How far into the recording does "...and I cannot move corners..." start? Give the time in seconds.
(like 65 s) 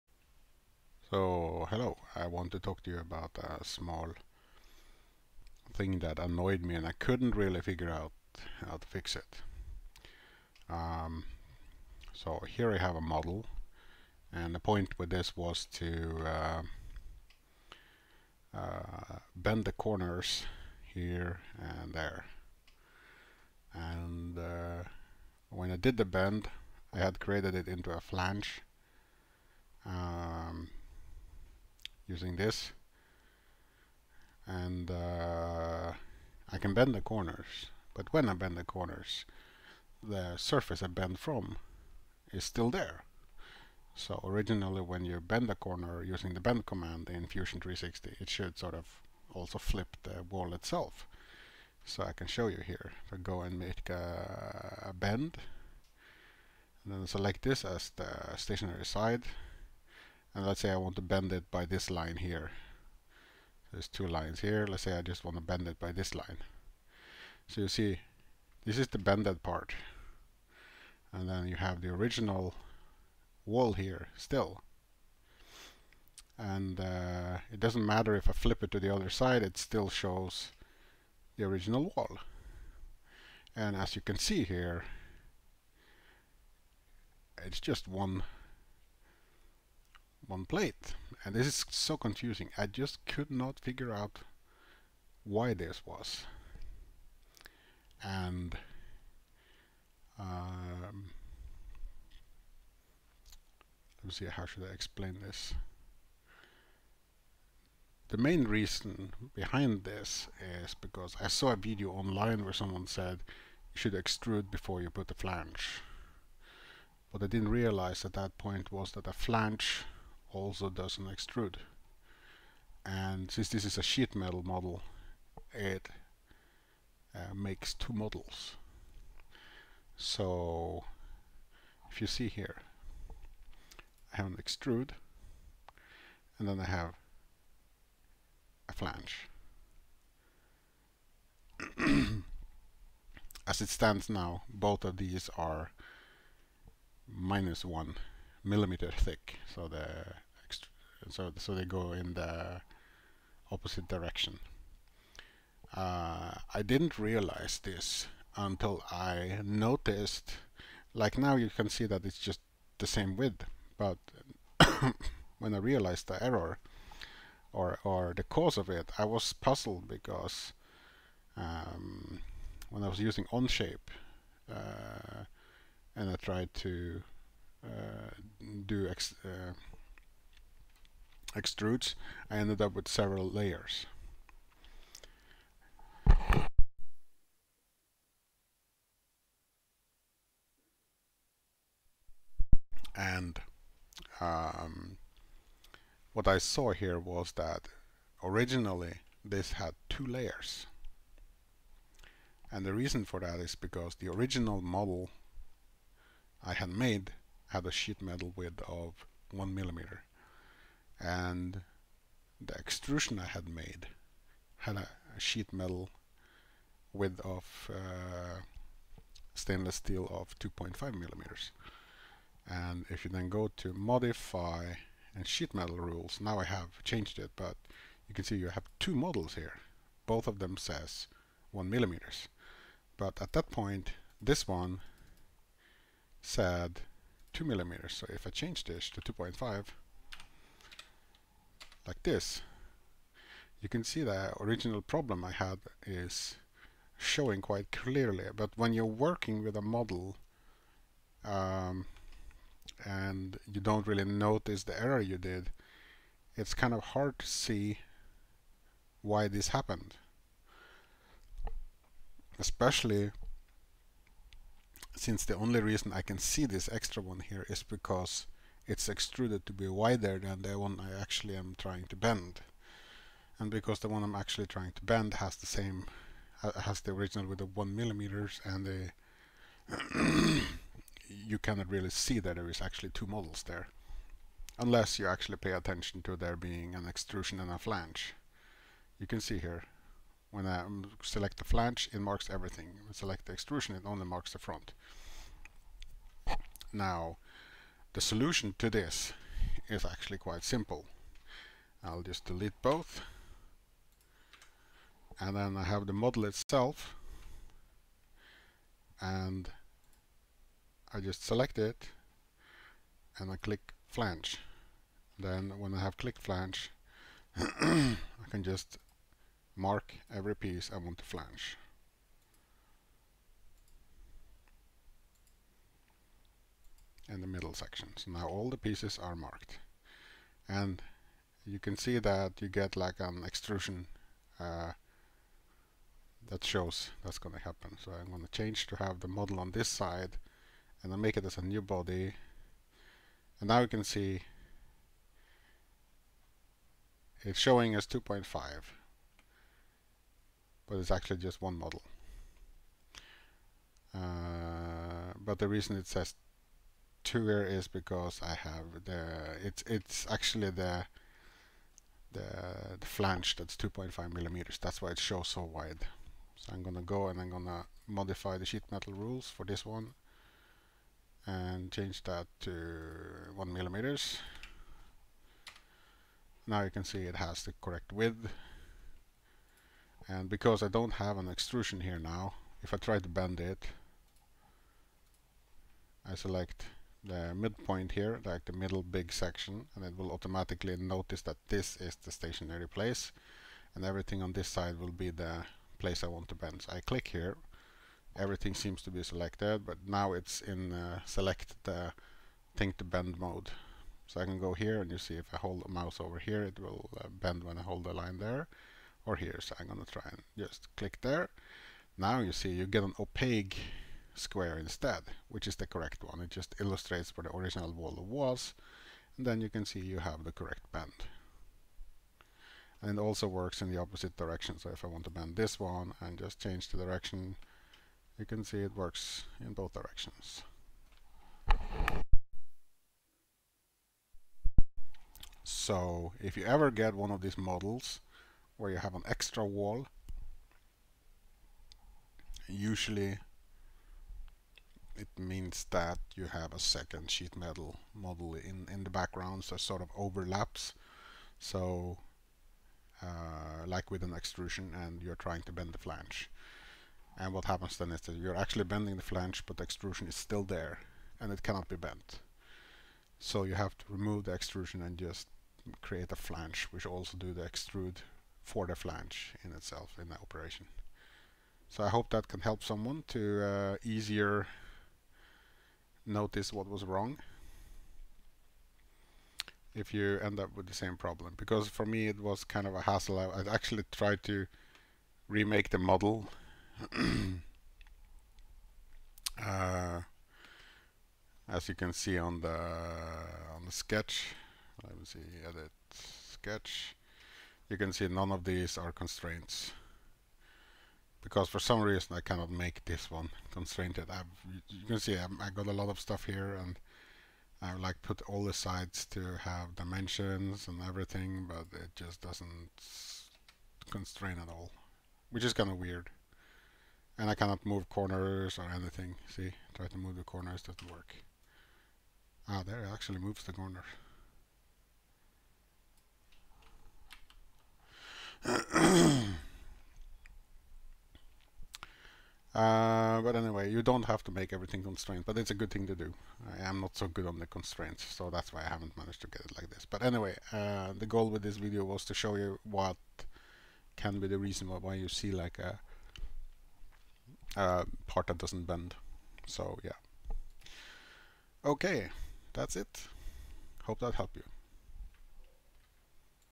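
517 s.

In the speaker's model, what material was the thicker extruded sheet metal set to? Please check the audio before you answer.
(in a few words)
stainless steel.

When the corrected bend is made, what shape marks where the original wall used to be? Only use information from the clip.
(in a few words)
opaque square.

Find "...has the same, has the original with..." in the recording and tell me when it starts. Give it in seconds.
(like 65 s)
275 s.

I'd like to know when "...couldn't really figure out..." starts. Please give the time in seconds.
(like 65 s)
6 s.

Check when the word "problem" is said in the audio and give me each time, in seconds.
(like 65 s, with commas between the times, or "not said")
244 s, 480 s.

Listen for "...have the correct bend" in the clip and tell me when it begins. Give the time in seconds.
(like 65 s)
419 s.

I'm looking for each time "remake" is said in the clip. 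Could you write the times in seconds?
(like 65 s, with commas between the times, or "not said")
485 s.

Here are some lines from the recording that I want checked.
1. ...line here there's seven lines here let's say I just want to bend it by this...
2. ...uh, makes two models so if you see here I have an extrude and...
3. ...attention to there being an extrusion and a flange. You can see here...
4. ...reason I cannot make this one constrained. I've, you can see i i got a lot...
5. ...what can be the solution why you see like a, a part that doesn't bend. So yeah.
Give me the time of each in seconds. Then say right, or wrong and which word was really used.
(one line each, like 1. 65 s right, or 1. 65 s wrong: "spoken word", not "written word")
1. 61 s wrong: "two", not "seven"
2. 127 s right
3. 285 s right
4. 501 s right
5. 542 s wrong: "reason", not "solution".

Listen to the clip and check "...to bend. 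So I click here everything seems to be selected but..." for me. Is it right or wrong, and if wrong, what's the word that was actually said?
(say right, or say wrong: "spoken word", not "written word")
right.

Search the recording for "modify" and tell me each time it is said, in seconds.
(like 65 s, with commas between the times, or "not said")
223 s, 367 s.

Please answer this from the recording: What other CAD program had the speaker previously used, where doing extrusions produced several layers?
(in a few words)
Onshape.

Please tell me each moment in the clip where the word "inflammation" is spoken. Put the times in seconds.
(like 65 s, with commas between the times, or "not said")
not said.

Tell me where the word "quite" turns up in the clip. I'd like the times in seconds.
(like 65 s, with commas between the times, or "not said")
247 s, 300 s.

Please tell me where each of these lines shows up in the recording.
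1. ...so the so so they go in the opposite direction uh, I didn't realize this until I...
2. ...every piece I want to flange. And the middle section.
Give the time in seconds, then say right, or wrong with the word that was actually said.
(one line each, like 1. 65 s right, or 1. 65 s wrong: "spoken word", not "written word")
1. 149 s right
2. 320 s right.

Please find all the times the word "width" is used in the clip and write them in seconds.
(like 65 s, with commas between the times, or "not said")
163 s, 208 s, 216 s, 377 s.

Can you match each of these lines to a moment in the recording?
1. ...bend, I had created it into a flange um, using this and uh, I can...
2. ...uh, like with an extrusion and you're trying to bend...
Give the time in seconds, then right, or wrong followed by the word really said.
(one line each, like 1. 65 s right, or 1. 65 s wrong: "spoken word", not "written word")
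1. 26 s right
2. 453 s right.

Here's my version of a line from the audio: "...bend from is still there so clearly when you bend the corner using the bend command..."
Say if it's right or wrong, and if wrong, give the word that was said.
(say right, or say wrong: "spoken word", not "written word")
wrong: "originally", not "clearly".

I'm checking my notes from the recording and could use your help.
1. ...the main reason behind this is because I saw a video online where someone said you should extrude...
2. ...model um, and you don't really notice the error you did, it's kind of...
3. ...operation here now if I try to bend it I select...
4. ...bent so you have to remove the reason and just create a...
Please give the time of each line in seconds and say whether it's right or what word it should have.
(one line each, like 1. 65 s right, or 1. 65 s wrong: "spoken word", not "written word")
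1. 108 s right
2. 249 s right
3. 381 s wrong: "extrusion", not "operation"
4. 461 s wrong: "extrusion", not "reason".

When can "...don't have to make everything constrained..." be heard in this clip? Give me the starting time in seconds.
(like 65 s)
533 s.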